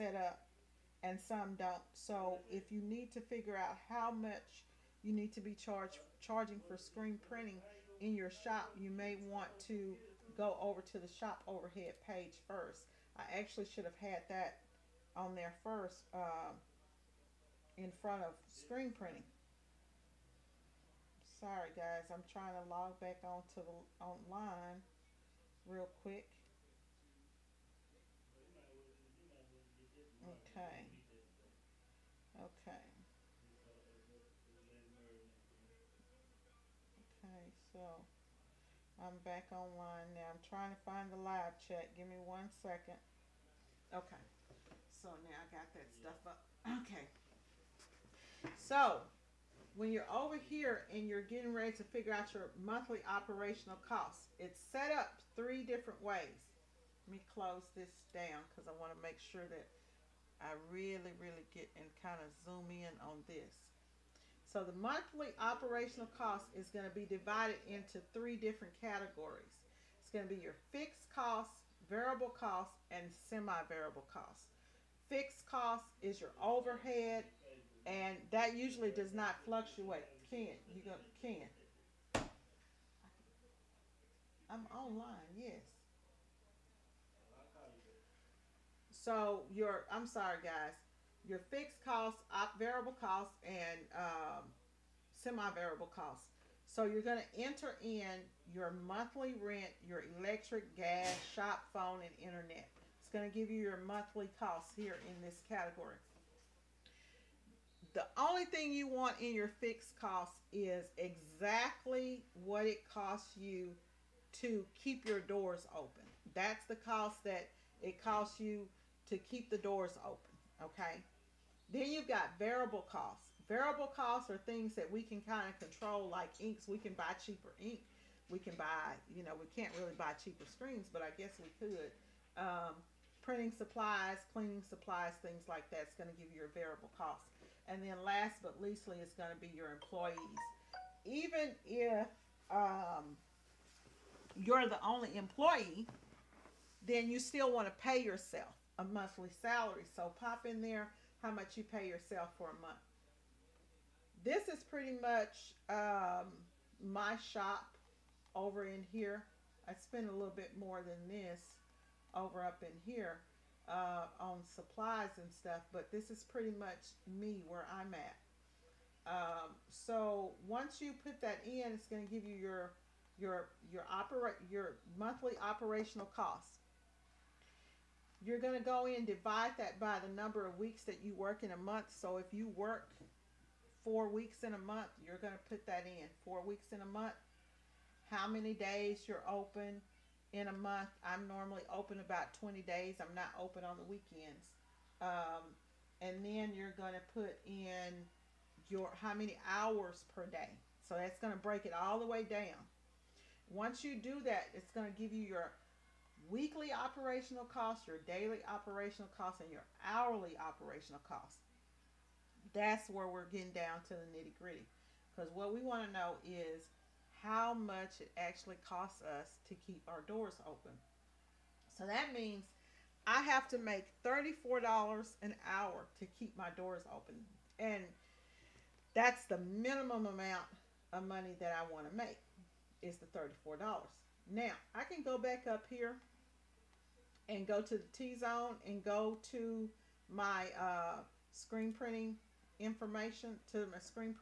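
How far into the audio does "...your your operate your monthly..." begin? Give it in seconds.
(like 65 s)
173 s.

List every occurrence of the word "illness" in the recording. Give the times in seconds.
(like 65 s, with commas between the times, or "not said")
not said.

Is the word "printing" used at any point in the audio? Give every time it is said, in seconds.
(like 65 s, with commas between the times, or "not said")
7 s, 18 s, 133 s, 241 s.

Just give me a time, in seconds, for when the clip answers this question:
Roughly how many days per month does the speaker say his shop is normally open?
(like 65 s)
192 s.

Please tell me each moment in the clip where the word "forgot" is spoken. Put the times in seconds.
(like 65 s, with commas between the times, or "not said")
not said.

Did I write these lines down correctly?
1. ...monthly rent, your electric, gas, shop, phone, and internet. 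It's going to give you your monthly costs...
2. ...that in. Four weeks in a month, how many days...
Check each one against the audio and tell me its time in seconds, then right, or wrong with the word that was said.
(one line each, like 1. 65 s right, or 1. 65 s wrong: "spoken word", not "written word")
1. 98 s right
2. 185 s right.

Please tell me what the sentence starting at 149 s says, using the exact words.
So pop in there how much you pay yourself for a month.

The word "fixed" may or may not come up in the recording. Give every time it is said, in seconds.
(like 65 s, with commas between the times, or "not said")
70 s, 75 s, 91 s, 109 s.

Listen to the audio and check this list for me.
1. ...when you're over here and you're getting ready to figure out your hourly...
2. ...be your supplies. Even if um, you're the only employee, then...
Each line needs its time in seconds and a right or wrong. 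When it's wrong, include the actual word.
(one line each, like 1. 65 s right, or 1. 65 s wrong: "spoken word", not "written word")
1. 49 s wrong: "monthly", not "hourly"
2. 139 s wrong: "employees", not "supplies".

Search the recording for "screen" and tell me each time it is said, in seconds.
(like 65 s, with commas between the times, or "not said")
6 s, 18 s, 130 s, 241 s.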